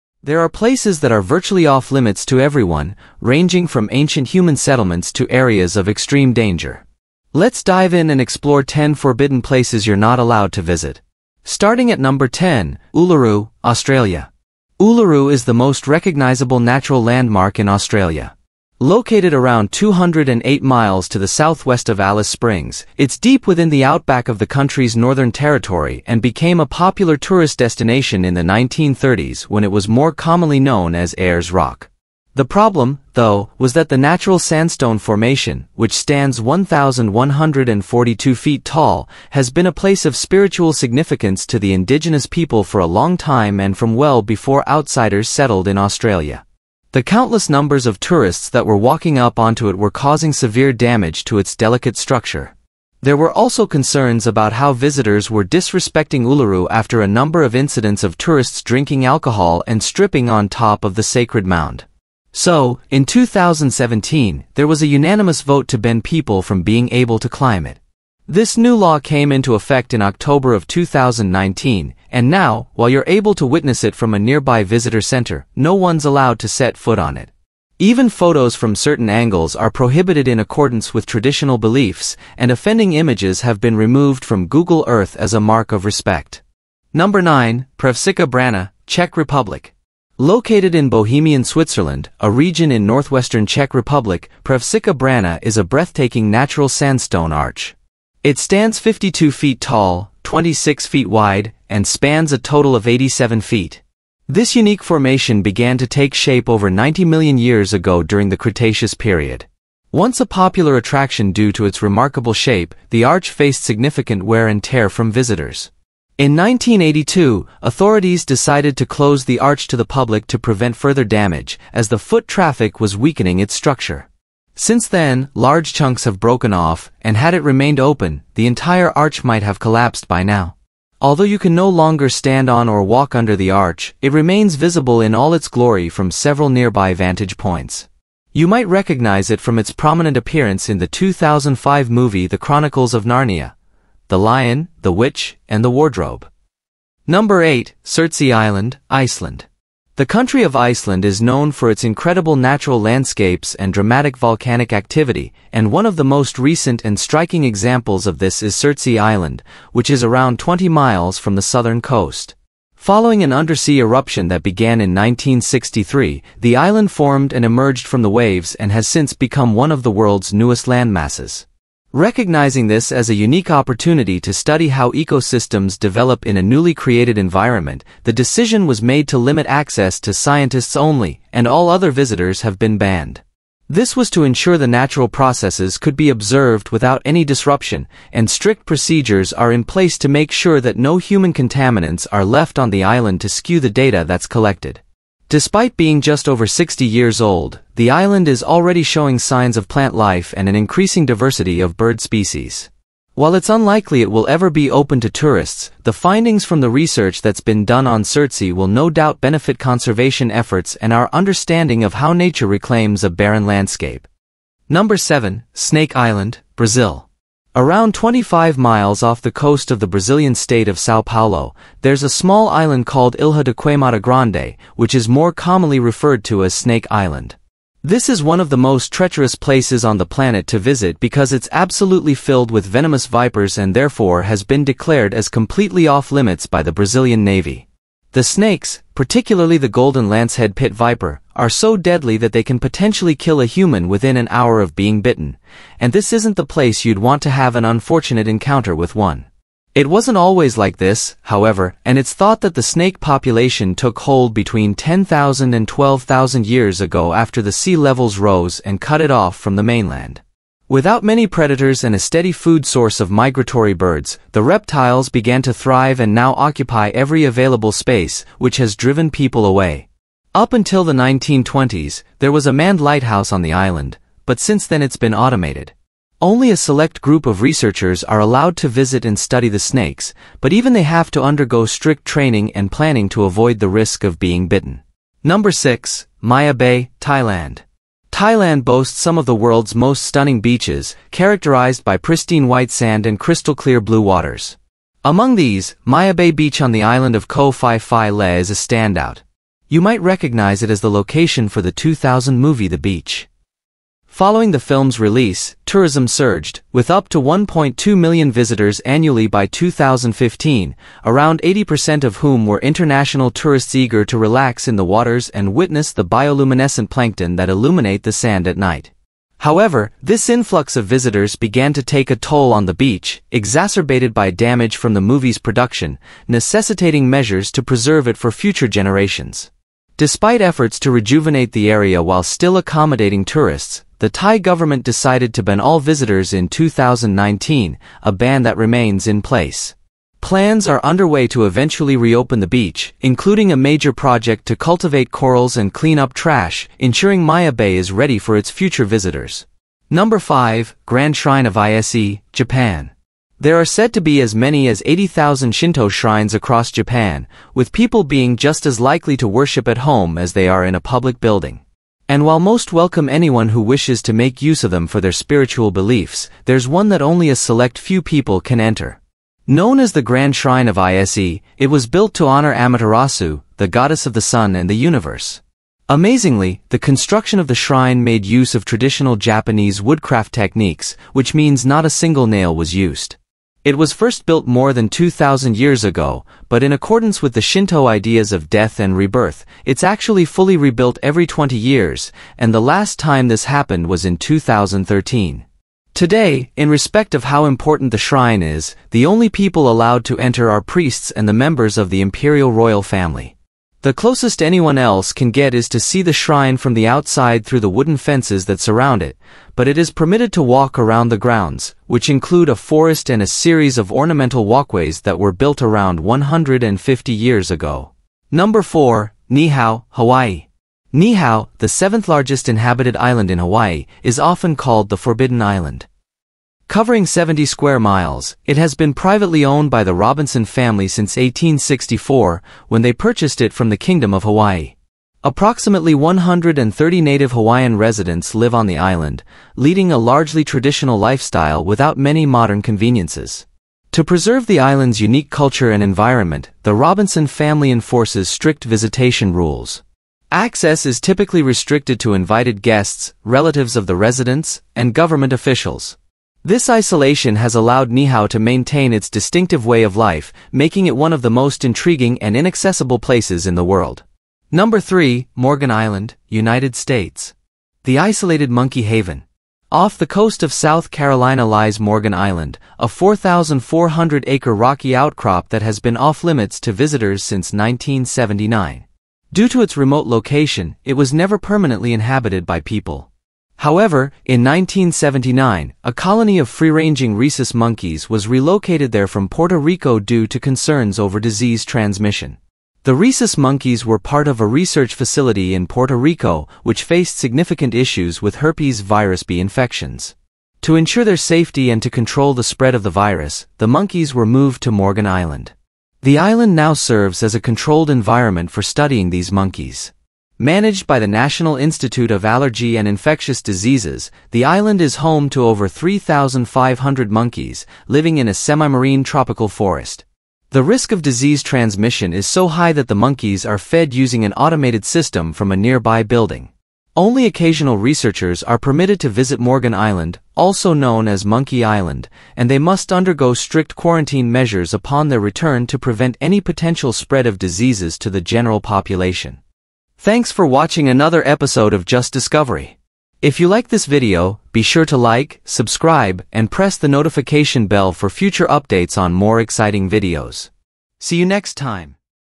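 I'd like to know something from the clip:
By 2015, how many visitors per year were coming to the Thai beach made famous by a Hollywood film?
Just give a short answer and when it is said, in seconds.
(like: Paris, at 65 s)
1.2 million, at 307 s.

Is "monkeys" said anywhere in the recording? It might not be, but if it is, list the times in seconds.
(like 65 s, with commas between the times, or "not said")
468 s, 487 s, 493 s, 503 s, 509 s, 517 s, 522 s, 531 s.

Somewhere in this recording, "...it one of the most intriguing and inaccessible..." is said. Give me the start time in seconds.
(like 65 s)
460 s.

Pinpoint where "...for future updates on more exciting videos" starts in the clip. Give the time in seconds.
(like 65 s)
547 s.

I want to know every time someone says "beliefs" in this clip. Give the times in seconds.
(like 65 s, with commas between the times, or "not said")
81 s, 365 s.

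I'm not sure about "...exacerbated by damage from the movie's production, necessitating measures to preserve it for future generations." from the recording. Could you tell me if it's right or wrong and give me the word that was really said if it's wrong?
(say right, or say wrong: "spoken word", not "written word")
right.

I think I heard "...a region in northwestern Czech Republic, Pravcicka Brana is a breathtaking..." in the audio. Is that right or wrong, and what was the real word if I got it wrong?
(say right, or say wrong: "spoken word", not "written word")
right.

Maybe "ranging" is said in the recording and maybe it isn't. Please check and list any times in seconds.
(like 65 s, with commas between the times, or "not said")
3 s, 486 s.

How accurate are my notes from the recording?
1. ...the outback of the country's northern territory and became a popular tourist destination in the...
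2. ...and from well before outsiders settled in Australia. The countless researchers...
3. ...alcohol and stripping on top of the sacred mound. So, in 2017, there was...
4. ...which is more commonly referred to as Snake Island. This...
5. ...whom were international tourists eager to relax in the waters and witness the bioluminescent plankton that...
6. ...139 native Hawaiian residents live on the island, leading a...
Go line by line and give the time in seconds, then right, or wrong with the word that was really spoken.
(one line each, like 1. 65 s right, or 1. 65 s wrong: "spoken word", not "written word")
1. 23 s right
2. 43 s wrong: "numbers", not "researchers"
3. 59 s right
4. 224 s right
5. 312 s right
6. 435 s wrong: "130", not "139".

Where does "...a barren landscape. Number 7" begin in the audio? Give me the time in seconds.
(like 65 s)
213 s.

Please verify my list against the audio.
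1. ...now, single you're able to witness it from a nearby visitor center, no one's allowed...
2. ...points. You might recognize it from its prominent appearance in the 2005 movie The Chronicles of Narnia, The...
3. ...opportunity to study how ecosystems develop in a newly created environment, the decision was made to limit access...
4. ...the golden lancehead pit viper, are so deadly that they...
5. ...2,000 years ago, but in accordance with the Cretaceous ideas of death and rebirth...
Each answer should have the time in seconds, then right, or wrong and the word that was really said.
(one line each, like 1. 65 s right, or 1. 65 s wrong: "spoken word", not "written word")
1. 72 s wrong: "while", not "single"
2. 137 s right
3. 173 s right
4. 239 s right
5. 384 s wrong: "Shinto", not "Cretaceous".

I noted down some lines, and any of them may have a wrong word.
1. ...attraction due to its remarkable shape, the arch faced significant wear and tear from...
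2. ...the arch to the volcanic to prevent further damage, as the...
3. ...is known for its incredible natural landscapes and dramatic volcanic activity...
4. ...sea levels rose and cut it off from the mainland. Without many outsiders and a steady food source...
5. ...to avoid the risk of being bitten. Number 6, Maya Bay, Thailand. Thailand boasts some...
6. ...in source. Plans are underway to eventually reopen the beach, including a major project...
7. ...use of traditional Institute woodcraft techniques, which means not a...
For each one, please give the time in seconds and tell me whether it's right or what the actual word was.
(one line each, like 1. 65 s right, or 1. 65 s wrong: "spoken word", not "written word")
1. 110 s right
2. 119 s wrong: "public", not "volcanic"
3. 151 s right
4. 257 s wrong: "predators", not "outsiders"
5. 283 s right
6. 339 s wrong: "place", not "source"
7. 378 s wrong: "Japanese", not "Institute".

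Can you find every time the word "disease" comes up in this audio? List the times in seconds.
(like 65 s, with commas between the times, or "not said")
491 s, 513 s, 521 s, 537 s.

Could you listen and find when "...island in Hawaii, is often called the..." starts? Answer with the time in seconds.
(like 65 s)
422 s.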